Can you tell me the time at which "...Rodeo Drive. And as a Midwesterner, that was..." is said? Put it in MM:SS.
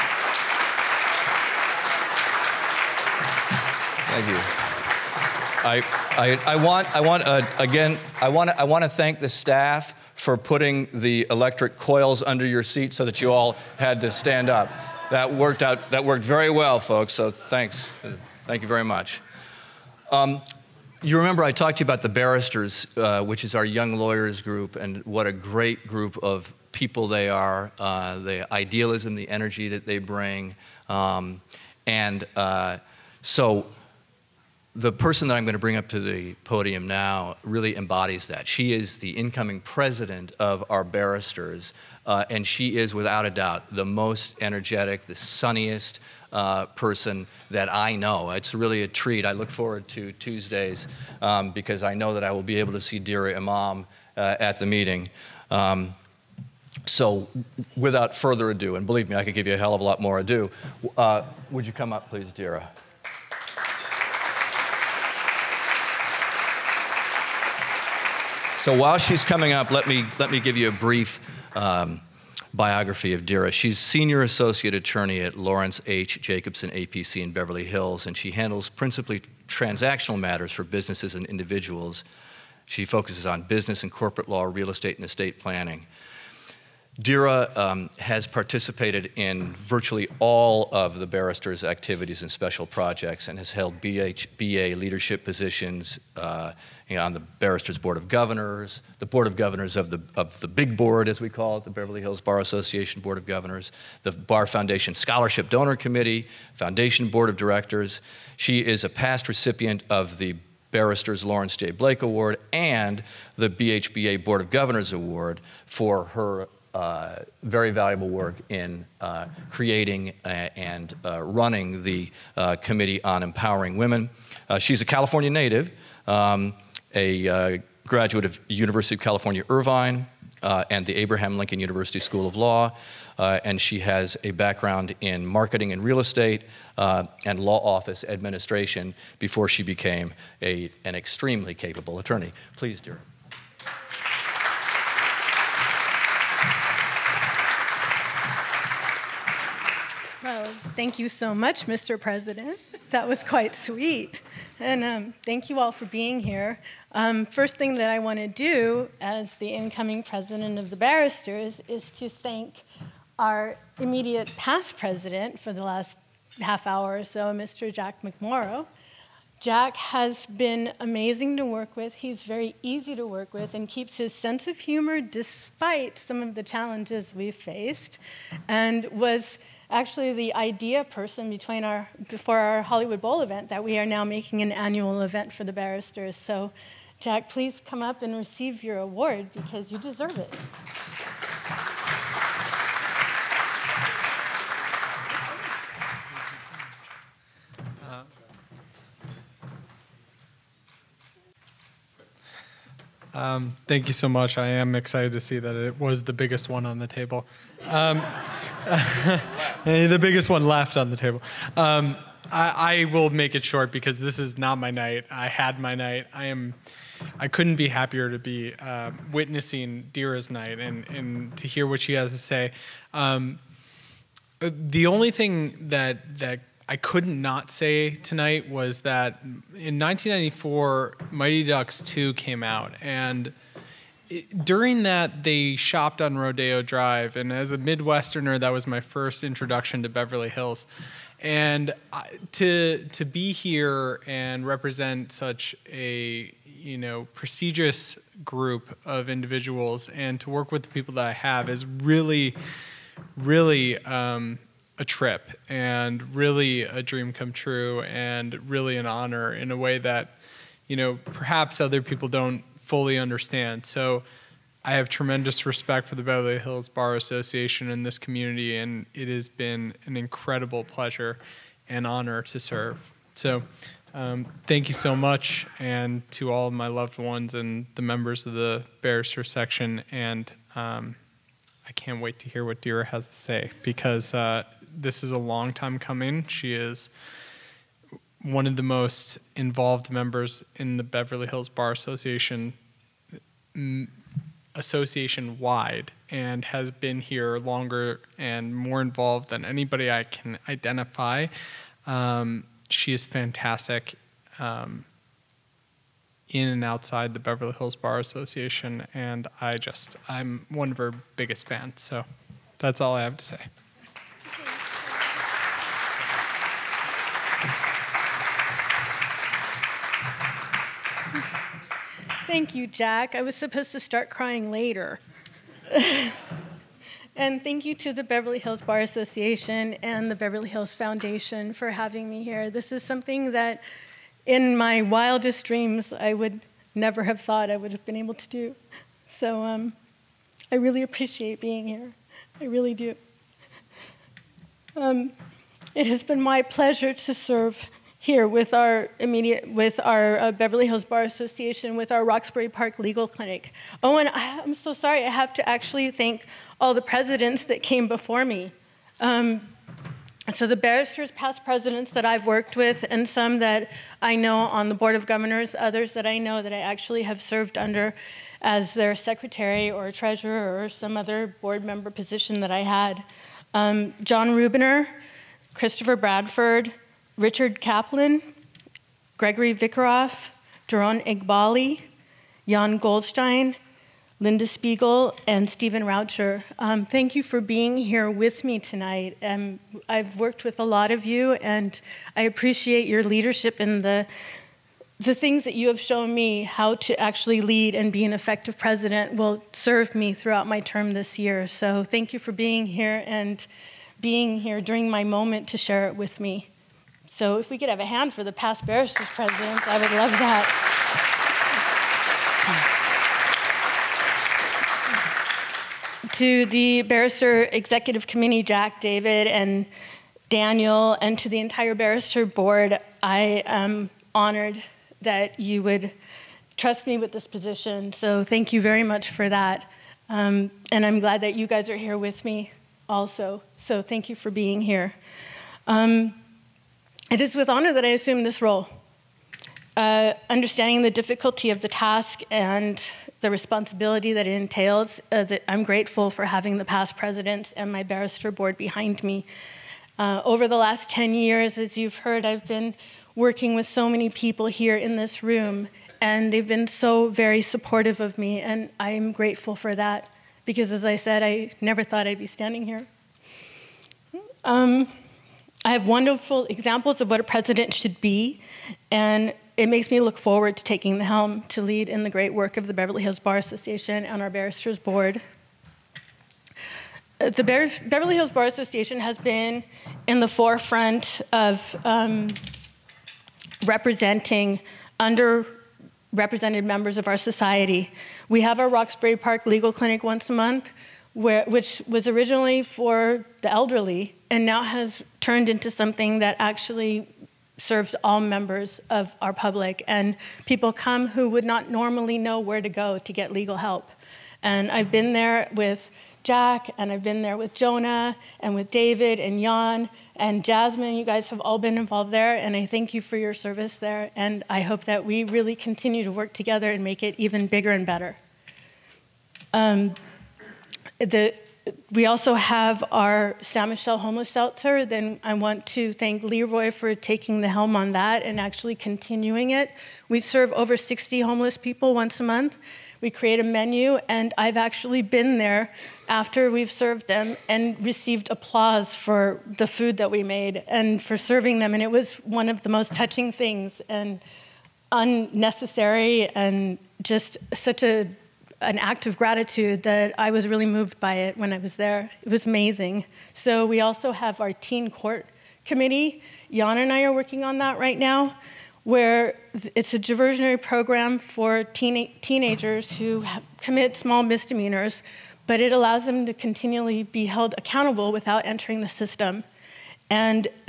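03:56.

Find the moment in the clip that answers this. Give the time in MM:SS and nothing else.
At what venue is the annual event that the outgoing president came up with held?
03:02.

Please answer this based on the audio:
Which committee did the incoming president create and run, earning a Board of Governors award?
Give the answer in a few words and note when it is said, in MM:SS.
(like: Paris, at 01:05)
Committee on Empowering Women, at 02:02.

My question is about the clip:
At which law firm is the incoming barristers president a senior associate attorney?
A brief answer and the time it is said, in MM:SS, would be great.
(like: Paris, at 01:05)
Lawrence H. Jacobson APC, at 01:15.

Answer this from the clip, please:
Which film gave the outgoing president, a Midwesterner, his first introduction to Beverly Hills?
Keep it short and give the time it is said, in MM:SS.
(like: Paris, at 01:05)
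Mighty Ducks 2, at 03:51.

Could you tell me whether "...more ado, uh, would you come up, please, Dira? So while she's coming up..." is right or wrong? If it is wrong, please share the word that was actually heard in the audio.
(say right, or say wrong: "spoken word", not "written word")
right.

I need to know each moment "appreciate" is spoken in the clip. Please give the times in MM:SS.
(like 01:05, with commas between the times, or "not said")
05:40, 06:32.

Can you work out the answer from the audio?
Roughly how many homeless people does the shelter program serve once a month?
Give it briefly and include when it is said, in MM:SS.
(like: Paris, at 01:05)
over 60, at 08:50.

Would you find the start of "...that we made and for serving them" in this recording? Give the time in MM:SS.
08:59.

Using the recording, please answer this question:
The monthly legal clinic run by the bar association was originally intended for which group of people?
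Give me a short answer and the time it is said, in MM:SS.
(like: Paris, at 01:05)
the elderly, at 08:13.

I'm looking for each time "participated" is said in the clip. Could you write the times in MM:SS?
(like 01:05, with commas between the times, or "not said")
01:28.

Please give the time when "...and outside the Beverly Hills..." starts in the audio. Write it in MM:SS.
05:06.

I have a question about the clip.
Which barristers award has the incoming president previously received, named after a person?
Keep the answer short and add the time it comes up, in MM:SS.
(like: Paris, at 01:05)
Lawrence J. Blake Award, at 01:51.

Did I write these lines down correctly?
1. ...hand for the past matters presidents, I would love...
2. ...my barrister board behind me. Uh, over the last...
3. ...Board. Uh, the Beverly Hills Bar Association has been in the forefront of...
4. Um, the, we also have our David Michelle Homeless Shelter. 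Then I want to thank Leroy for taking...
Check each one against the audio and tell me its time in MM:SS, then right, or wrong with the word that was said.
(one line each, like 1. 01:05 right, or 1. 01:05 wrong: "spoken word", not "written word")
1. 06:47 wrong: "barristers", not "matters"
2. 07:27 right
3. 07:54 right
4. 08:39 wrong: "San", not "David".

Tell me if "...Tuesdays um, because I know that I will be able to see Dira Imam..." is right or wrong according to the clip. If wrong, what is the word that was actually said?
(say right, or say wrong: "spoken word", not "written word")
right.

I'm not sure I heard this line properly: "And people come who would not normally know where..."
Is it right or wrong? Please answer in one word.
right.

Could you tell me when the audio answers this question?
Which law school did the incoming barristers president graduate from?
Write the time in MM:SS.
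02:10.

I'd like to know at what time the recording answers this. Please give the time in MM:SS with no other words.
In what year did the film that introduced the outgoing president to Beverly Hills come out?
03:49.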